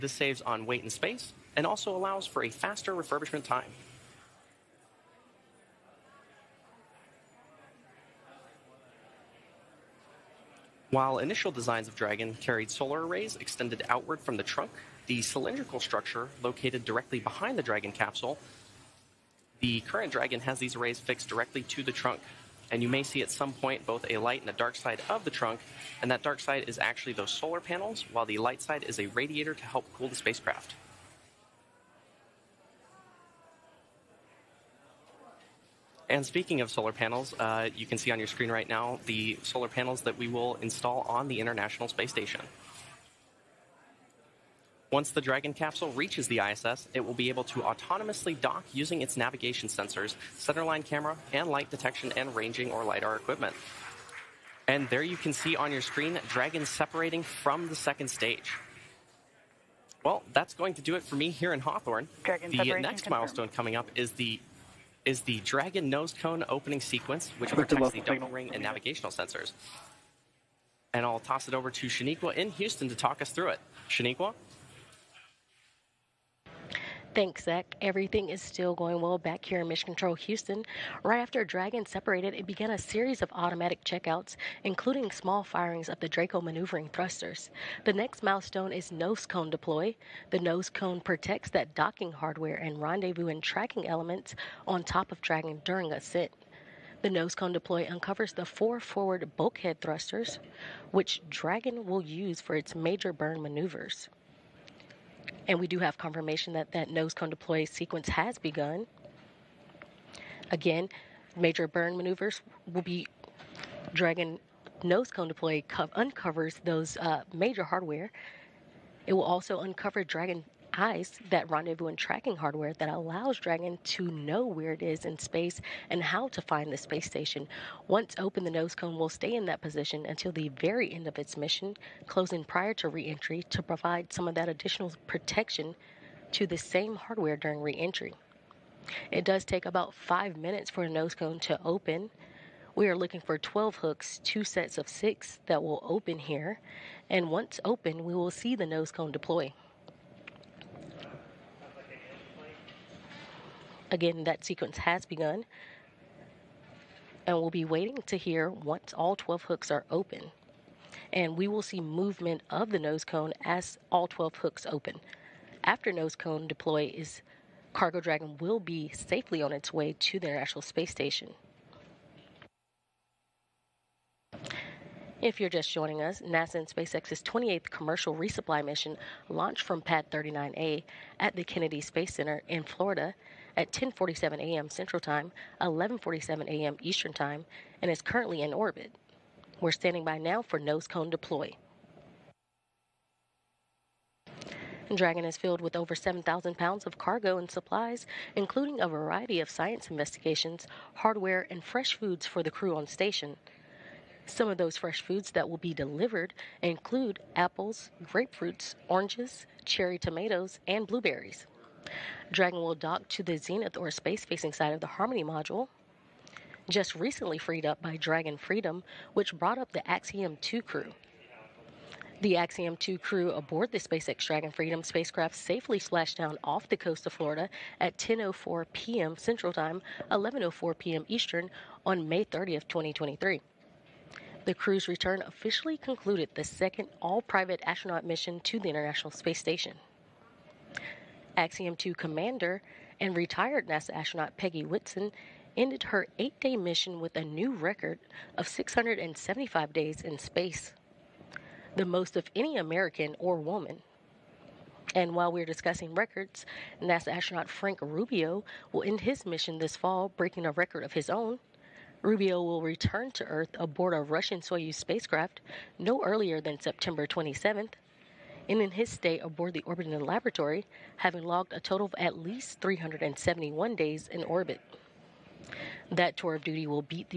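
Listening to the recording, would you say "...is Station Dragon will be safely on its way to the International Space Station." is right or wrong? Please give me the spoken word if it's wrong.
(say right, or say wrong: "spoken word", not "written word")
wrong: "Cargo", not "Station".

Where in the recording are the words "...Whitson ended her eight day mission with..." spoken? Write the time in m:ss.
4:04.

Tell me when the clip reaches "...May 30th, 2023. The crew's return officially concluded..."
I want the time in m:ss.
3:52.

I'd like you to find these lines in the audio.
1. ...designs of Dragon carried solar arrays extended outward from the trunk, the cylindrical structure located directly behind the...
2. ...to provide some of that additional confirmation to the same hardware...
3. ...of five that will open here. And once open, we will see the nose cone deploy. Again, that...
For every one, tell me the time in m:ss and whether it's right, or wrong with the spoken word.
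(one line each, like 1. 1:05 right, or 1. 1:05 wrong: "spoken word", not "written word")
1. 0:11 right
2. 2:13 wrong: "protection", not "confirmation"
3. 2:24 wrong: "six", not "five".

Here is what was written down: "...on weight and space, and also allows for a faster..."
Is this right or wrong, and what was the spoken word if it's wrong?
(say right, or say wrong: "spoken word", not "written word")
right.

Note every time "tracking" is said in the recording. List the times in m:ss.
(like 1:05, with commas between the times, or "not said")
1:33, 2:01.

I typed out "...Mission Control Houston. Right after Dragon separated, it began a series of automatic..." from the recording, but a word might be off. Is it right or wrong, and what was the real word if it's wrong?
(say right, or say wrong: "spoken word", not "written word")
right.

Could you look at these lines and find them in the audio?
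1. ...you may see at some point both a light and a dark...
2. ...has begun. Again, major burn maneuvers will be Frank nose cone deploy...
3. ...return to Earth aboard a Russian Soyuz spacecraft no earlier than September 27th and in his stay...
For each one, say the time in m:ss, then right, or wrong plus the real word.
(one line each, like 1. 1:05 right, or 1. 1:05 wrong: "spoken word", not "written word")
1. 0:22 right
2. 1:48 wrong: "Dragon", not "Frank"
3. 4:22 right.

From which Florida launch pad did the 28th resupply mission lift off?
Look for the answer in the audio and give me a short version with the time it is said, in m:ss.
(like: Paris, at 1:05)
Pad 39A, at 2:59.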